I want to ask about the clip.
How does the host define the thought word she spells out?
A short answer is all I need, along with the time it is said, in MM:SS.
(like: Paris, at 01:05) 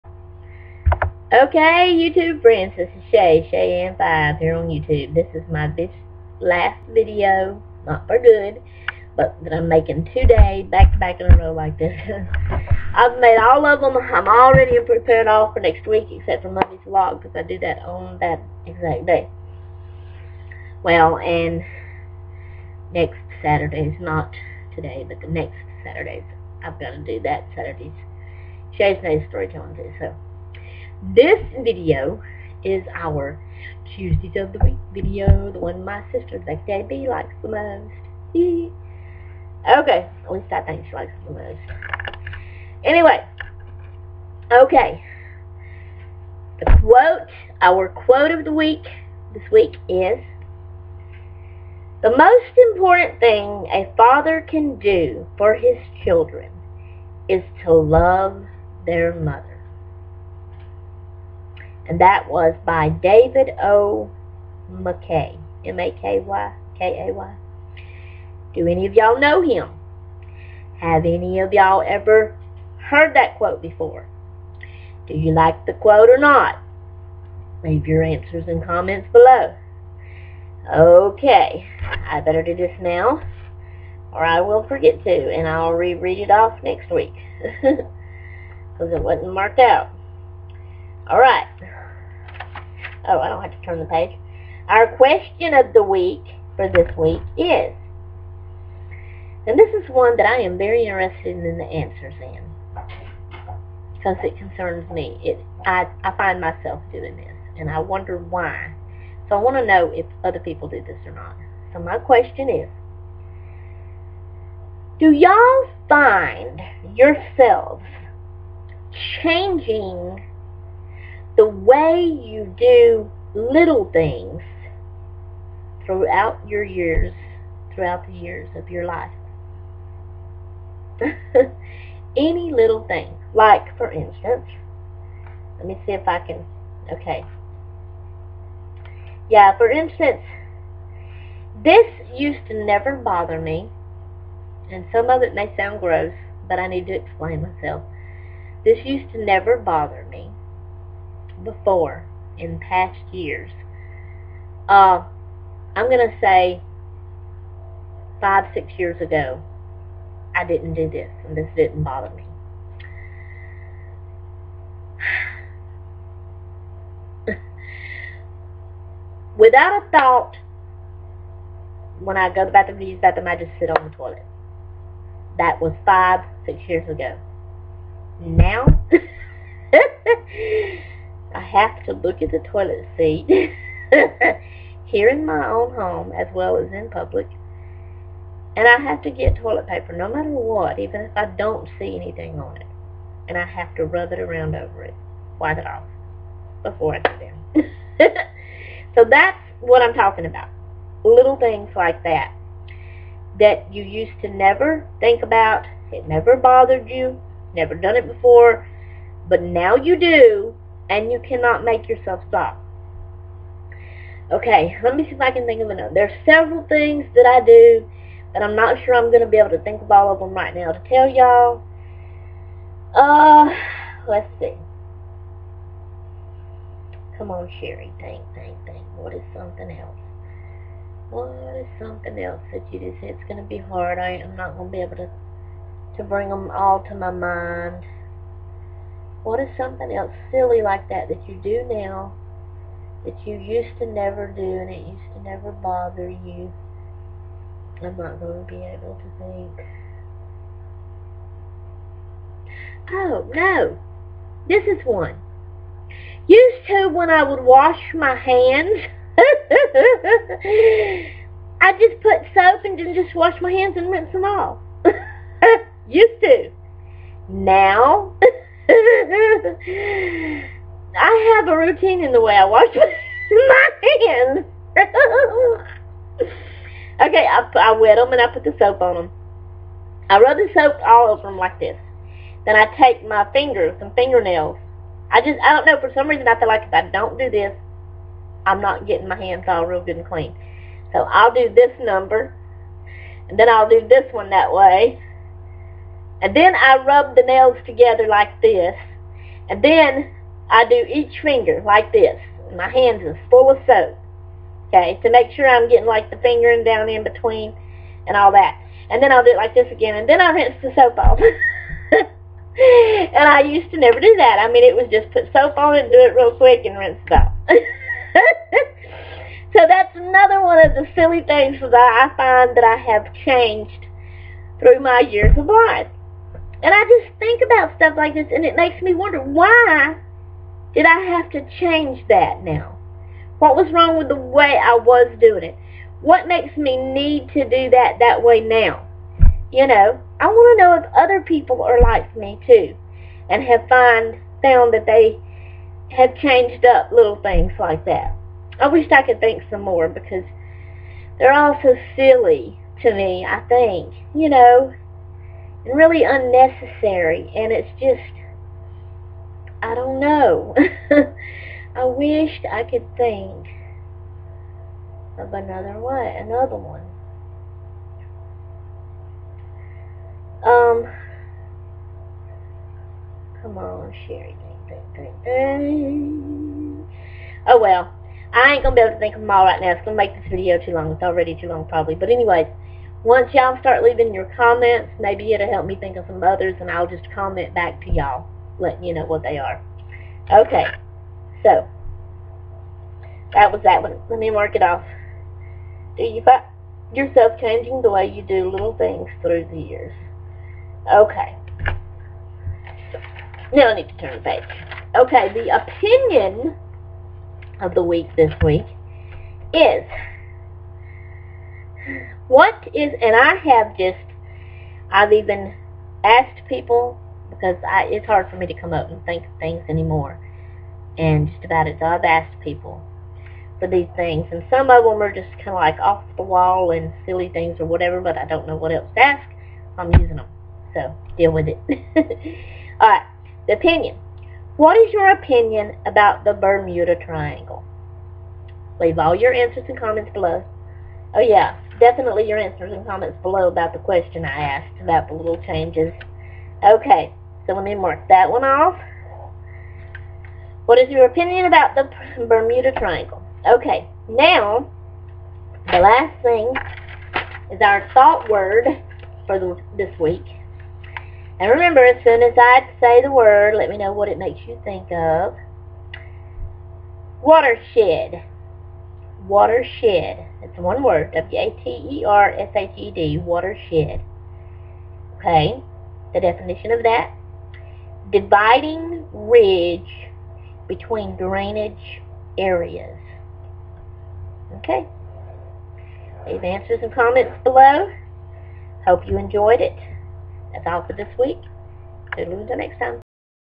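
Dividing ridge between drainage areas, at 07:58.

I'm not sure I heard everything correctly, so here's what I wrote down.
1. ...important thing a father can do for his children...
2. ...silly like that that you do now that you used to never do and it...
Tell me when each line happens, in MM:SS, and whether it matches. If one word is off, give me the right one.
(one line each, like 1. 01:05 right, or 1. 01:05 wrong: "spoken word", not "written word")
1. 00:52 right
2. 04:00 right.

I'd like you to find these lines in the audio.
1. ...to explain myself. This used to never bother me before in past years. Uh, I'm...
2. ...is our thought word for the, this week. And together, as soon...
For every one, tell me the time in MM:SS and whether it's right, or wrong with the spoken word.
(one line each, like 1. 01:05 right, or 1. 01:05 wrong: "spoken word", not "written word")
1. 02:26 right
2. 07:37 wrong: "remember", not "together".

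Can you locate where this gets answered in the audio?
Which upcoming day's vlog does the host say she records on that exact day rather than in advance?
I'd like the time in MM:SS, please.
00:16.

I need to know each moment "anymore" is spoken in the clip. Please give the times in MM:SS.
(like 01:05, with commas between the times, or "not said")
06:59.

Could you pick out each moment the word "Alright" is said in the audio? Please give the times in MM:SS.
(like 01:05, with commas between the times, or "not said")
01:31, 07:12.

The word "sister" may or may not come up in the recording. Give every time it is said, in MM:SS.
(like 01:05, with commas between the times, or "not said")
00:36.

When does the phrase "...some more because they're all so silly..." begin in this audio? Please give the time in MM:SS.
05:49.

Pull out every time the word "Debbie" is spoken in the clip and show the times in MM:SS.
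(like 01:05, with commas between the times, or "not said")
00:36.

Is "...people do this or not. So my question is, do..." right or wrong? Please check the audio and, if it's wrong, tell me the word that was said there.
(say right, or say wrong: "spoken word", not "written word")
right.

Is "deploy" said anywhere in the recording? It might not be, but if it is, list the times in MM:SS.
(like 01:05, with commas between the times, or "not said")
not said.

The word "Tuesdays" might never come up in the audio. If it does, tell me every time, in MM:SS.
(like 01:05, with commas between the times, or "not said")
00:33.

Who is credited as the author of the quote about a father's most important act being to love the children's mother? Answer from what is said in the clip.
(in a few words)
David O. McKay.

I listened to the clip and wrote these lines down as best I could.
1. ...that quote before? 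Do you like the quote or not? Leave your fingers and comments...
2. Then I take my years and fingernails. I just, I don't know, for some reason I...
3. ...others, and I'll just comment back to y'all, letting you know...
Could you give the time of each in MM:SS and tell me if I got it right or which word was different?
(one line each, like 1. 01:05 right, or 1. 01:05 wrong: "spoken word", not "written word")
1. 01:13 wrong: "answers", not "fingers"
2. 04:42 wrong: "fingers", not "years"
3. 06:26 right.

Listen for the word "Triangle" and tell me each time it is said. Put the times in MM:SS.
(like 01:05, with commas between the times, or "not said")
07:17, 07:32.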